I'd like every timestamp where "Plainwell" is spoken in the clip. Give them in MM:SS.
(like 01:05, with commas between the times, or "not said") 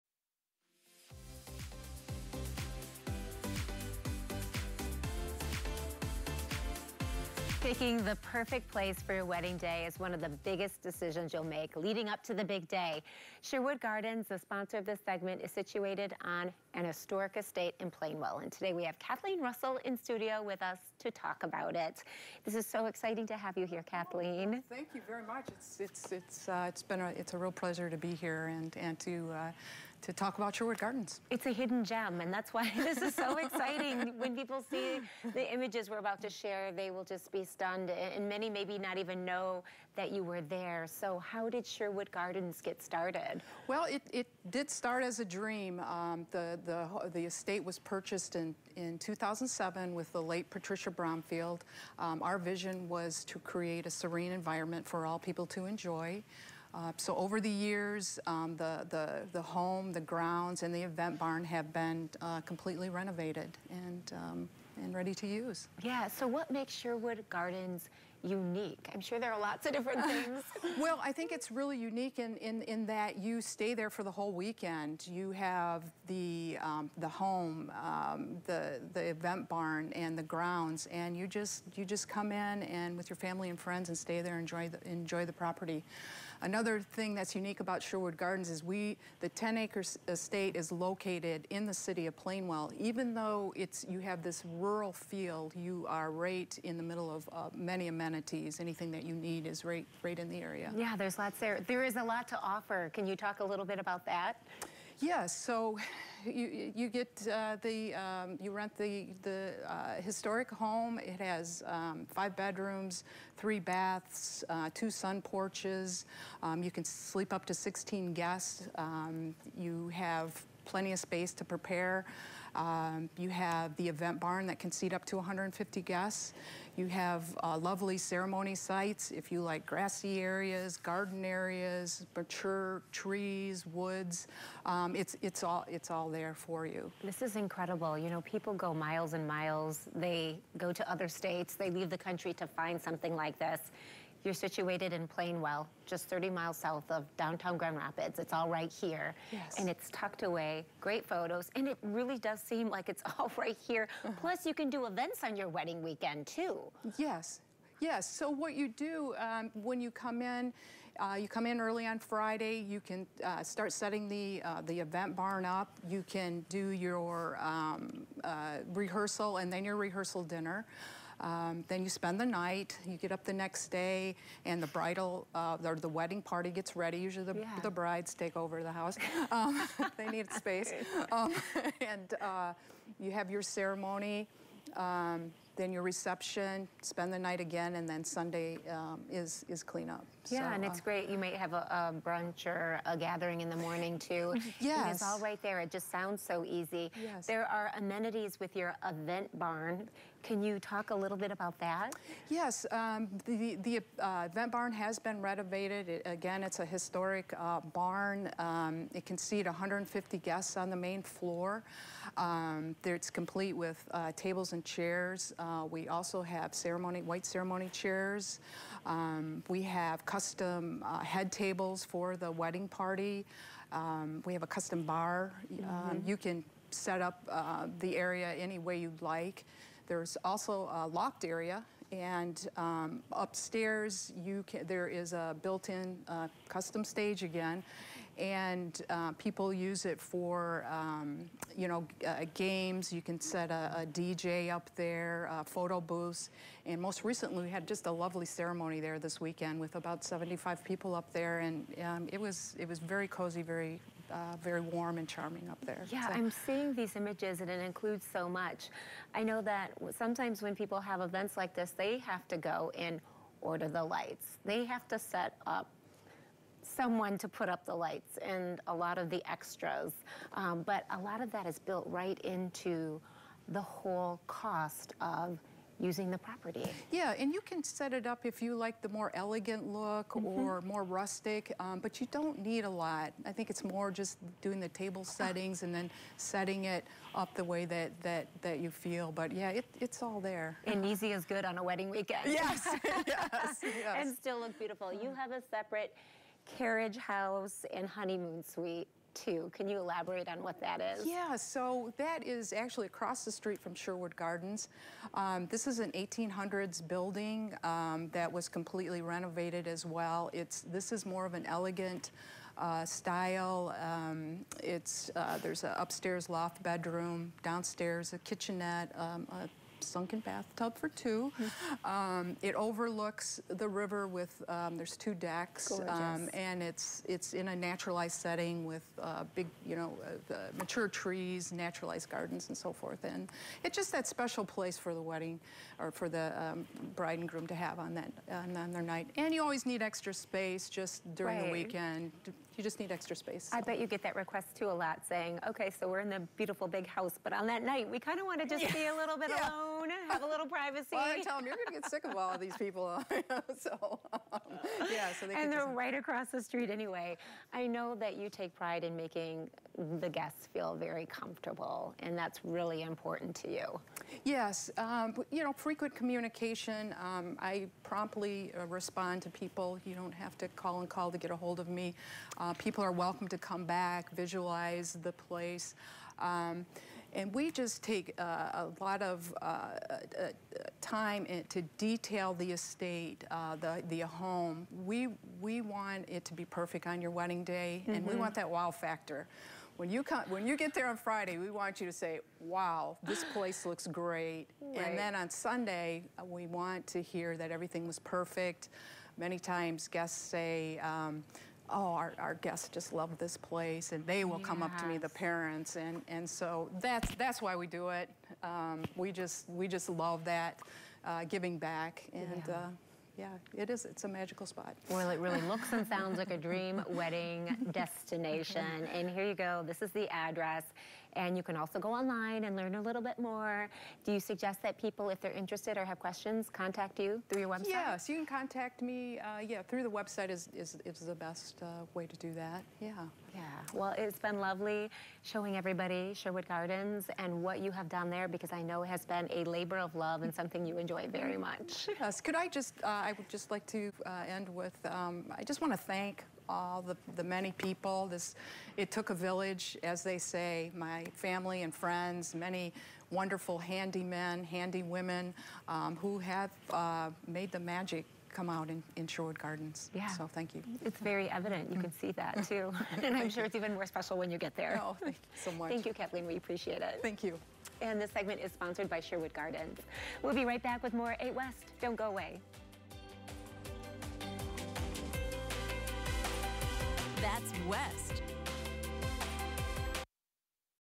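00:17, 01:32, 02:25.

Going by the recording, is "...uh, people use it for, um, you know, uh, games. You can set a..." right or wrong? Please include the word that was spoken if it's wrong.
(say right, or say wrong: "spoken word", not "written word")
right.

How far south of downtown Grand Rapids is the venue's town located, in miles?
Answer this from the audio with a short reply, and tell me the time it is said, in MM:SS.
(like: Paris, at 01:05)
30 miles, at 02:26.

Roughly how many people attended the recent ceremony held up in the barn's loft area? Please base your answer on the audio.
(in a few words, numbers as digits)
75.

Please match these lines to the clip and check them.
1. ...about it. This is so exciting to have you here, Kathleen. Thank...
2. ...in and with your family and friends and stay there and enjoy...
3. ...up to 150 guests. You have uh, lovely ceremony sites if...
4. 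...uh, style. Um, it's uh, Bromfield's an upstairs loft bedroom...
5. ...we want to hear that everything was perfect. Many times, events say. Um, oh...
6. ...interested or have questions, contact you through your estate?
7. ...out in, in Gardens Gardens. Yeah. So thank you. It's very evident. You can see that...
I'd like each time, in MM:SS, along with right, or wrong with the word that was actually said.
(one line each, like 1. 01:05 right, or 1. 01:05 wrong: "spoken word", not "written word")
1. 00:21 right
2. 01:22 right
3. 02:04 right
4. 05:12 wrong: "There", not "Bromfield"
5. 06:36 wrong: "guests", not "events"
6. 07:05 wrong: "website", not "estate"
7. 07:38 wrong: "Sherwood", not "Gardens".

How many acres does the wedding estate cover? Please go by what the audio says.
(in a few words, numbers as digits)
10.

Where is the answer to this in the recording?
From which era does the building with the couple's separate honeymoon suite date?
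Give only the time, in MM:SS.
05:05.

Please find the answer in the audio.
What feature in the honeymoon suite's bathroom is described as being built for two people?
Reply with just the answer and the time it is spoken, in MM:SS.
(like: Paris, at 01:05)
sunken bathtub, at 05:19.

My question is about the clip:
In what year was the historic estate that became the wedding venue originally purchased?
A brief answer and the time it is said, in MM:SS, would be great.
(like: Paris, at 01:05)
2007, at 00:48.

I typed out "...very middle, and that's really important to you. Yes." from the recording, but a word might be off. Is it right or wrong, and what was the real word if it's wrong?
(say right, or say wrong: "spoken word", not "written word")
wrong: "comfortable", not "middle".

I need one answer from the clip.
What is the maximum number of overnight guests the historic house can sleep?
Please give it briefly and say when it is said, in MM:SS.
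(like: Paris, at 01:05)
16, at 01:57.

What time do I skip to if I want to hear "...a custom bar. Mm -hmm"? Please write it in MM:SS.
03:44.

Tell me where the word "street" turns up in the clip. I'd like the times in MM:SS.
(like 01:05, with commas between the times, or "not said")
05:03, 05:56.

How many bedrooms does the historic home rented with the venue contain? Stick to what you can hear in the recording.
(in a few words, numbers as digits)
5.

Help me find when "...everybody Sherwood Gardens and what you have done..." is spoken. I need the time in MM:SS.
07:15.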